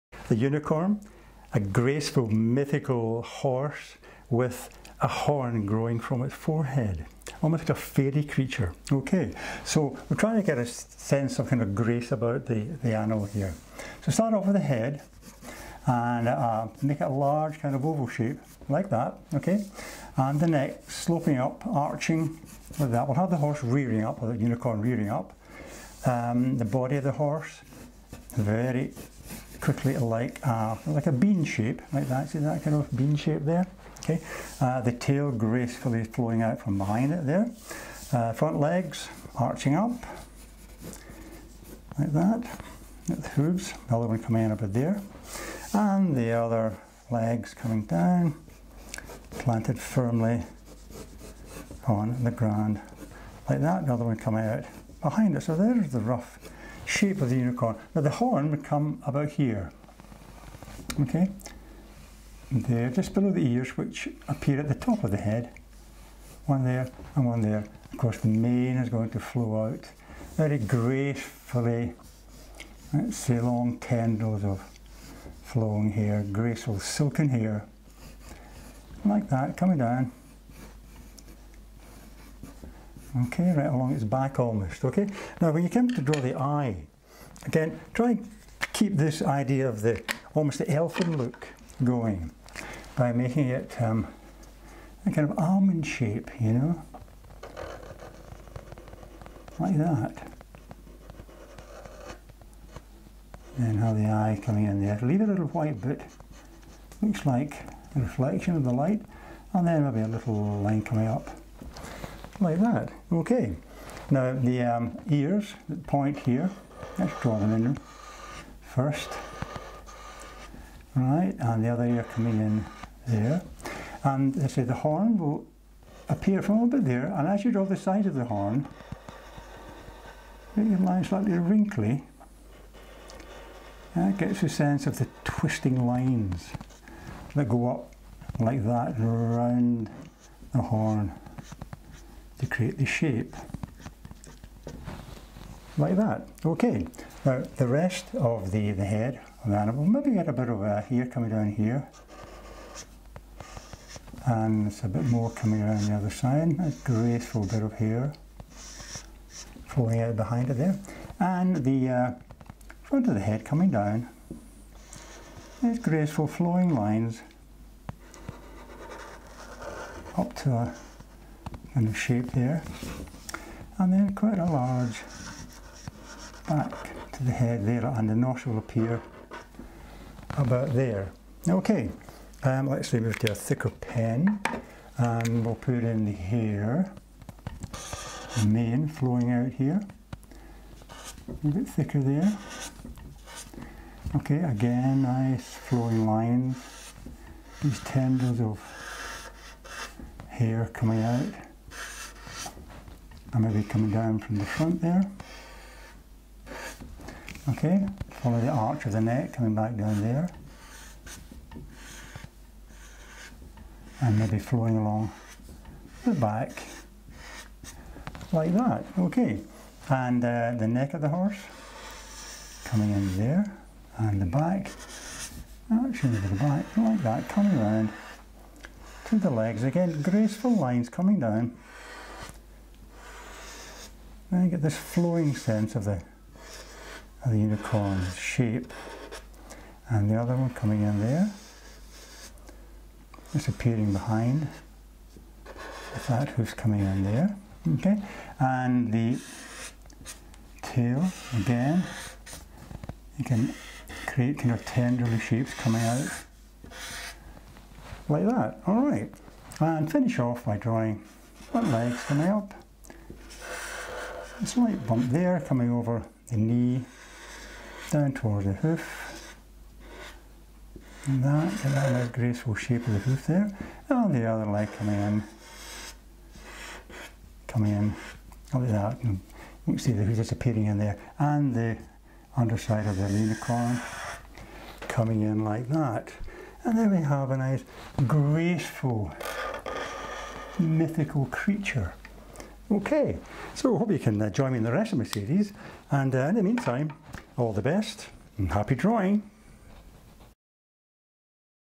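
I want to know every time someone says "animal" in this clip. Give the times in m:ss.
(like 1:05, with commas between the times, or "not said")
0:12, 2:29.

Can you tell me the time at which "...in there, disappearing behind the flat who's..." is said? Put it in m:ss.
4:00.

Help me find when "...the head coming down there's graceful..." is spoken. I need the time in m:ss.
2:43.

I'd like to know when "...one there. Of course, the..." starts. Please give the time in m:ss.
1:07.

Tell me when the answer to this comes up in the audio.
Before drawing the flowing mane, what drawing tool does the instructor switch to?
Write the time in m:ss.
3:03.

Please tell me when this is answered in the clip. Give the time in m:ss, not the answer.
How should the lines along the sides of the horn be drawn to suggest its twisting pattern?
2:11.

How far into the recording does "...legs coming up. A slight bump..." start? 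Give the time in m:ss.
4:21.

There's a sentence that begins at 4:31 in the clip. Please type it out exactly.
And that, get that nice graceful shape of the hoof there.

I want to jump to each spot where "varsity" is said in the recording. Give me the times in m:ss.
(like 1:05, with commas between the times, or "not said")
not said.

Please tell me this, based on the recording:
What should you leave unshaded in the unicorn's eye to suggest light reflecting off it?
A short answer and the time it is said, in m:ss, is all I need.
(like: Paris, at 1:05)
a little white bit, at 1:45.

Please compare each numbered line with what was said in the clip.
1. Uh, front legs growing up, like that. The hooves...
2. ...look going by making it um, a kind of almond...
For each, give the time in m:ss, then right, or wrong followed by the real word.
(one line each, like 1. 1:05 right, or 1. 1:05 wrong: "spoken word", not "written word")
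1. 0:38 wrong: "arching", not "growing"
2. 1:31 right.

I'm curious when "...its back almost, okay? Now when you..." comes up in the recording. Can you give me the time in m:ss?
1:23.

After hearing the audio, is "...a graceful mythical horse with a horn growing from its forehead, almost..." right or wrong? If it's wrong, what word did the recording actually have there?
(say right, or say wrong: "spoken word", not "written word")
right.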